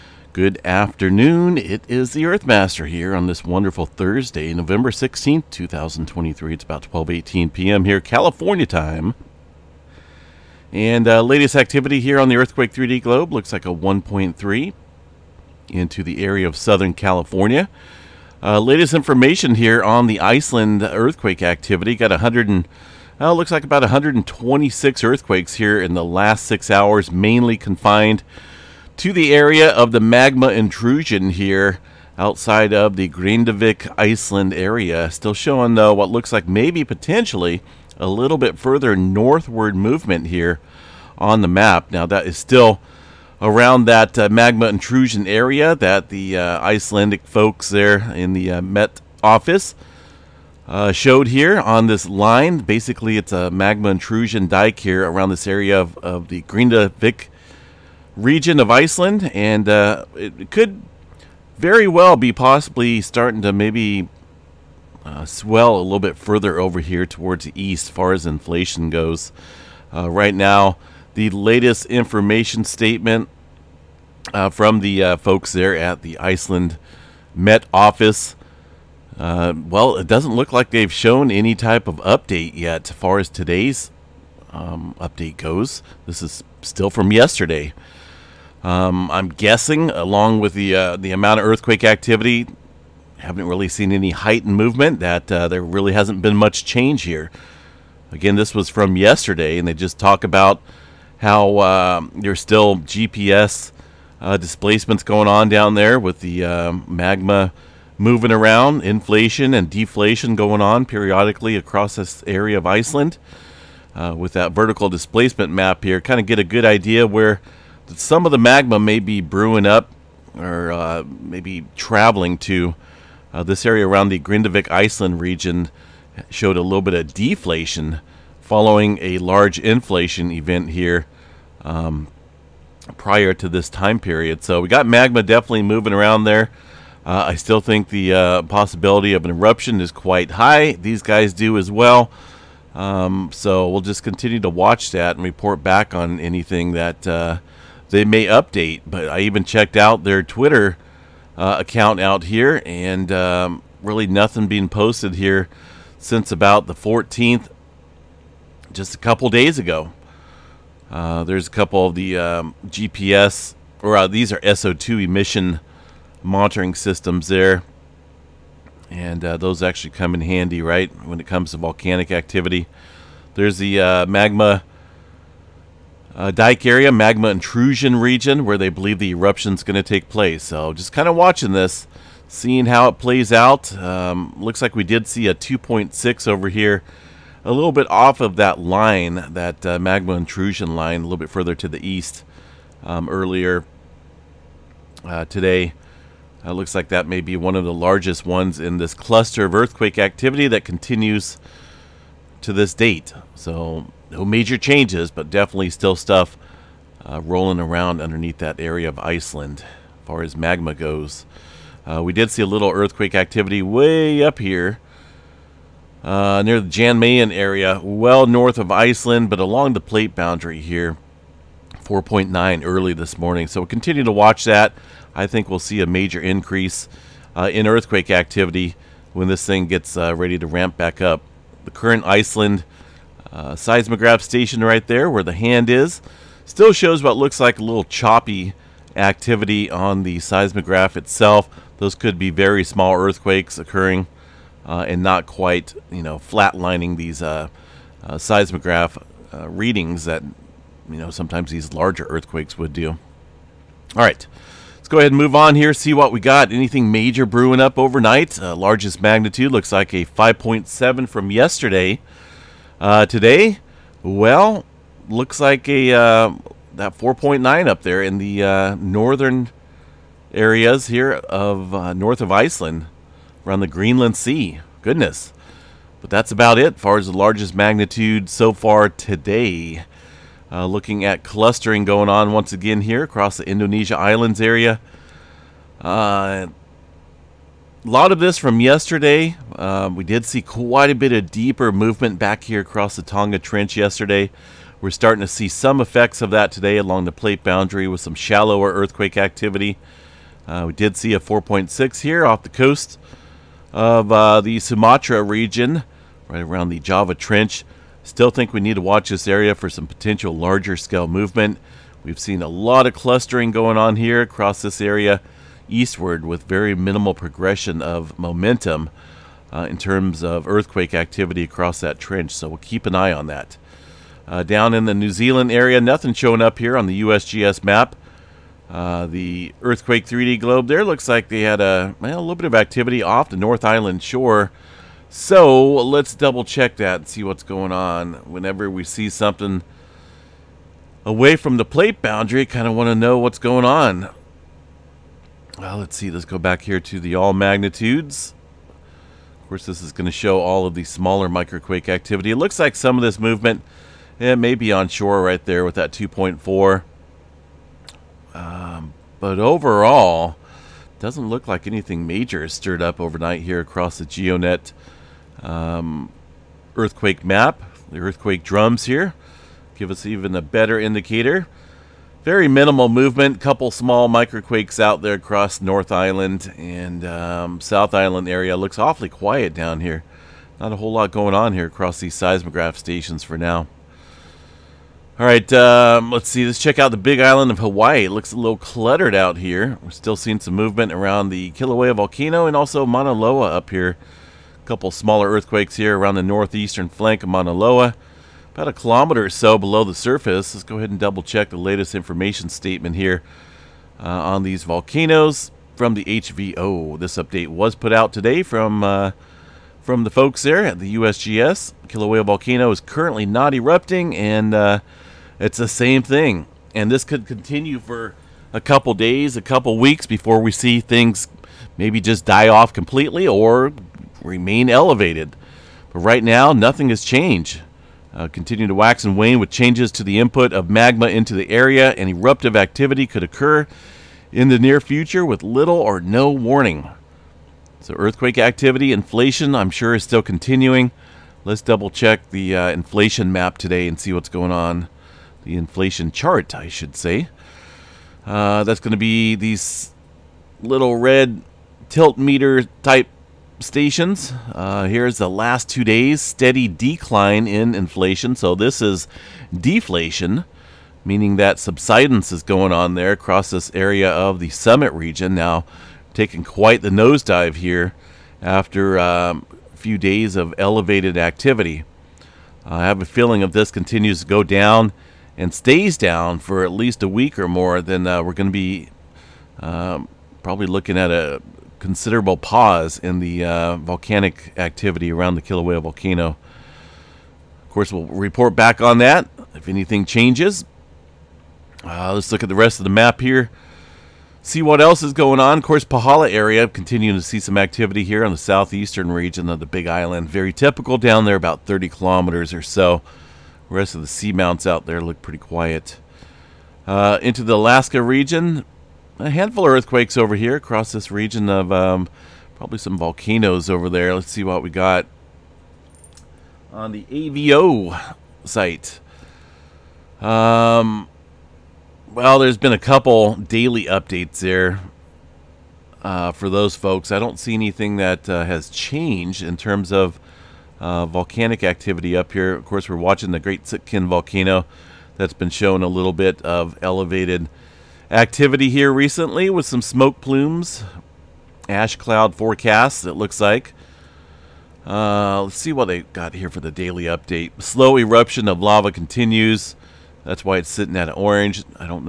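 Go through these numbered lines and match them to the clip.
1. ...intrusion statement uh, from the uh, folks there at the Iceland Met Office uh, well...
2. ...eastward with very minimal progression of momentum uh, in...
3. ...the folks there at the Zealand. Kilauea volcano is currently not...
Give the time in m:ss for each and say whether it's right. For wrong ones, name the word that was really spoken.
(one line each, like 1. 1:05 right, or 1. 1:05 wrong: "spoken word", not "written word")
1. 1:11 wrong: "information", not "intrusion"
2. 5:15 right
3. 6:50 wrong: "USGS", not "Zealand".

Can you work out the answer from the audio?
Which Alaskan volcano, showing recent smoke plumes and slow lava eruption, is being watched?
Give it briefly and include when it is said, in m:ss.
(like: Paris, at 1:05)
Great Sitkin, at 8:53.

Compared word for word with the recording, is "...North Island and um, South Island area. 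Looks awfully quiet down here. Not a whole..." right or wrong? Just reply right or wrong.
right.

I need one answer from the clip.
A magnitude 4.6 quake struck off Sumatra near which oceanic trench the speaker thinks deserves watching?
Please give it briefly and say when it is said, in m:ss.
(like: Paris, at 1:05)
Java Trench, at 5:06.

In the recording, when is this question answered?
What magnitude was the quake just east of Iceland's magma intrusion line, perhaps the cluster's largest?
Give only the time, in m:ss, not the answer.
3:05.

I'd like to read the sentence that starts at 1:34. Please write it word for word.
That uh, there really hasn't been much change here.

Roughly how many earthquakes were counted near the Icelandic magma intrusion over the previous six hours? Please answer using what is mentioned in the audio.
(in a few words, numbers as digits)
126.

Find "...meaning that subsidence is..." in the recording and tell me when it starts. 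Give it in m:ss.
7:41.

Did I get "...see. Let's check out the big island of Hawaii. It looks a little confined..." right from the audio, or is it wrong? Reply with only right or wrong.
wrong.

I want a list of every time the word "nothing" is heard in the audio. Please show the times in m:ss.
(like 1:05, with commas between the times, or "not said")
2:34, 5:25, 7:06.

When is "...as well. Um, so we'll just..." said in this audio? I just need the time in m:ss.
2:21.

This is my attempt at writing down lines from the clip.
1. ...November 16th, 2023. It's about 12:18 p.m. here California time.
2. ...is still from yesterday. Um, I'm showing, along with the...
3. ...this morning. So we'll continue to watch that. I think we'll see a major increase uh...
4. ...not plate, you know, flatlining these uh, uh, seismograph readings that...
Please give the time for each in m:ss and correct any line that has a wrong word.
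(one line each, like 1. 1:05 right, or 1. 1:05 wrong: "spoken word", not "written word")
1. 0:04 right
2. 1:26 wrong: "guessing", not "showing"
3. 3:42 right
4. 4:05 wrong: "quite", not "plate".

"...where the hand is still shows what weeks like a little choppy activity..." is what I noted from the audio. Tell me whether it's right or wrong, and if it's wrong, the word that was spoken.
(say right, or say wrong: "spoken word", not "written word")
wrong: "looks", not "weeks".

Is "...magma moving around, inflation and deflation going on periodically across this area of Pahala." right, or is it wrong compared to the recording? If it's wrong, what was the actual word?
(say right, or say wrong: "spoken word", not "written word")
wrong: "Iceland", not "Pahala".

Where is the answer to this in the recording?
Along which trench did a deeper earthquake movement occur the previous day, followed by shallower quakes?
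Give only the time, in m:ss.
4:53.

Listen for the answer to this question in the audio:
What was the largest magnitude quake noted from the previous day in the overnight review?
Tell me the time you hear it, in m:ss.
4:20.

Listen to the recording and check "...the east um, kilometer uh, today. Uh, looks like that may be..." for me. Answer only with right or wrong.
wrong.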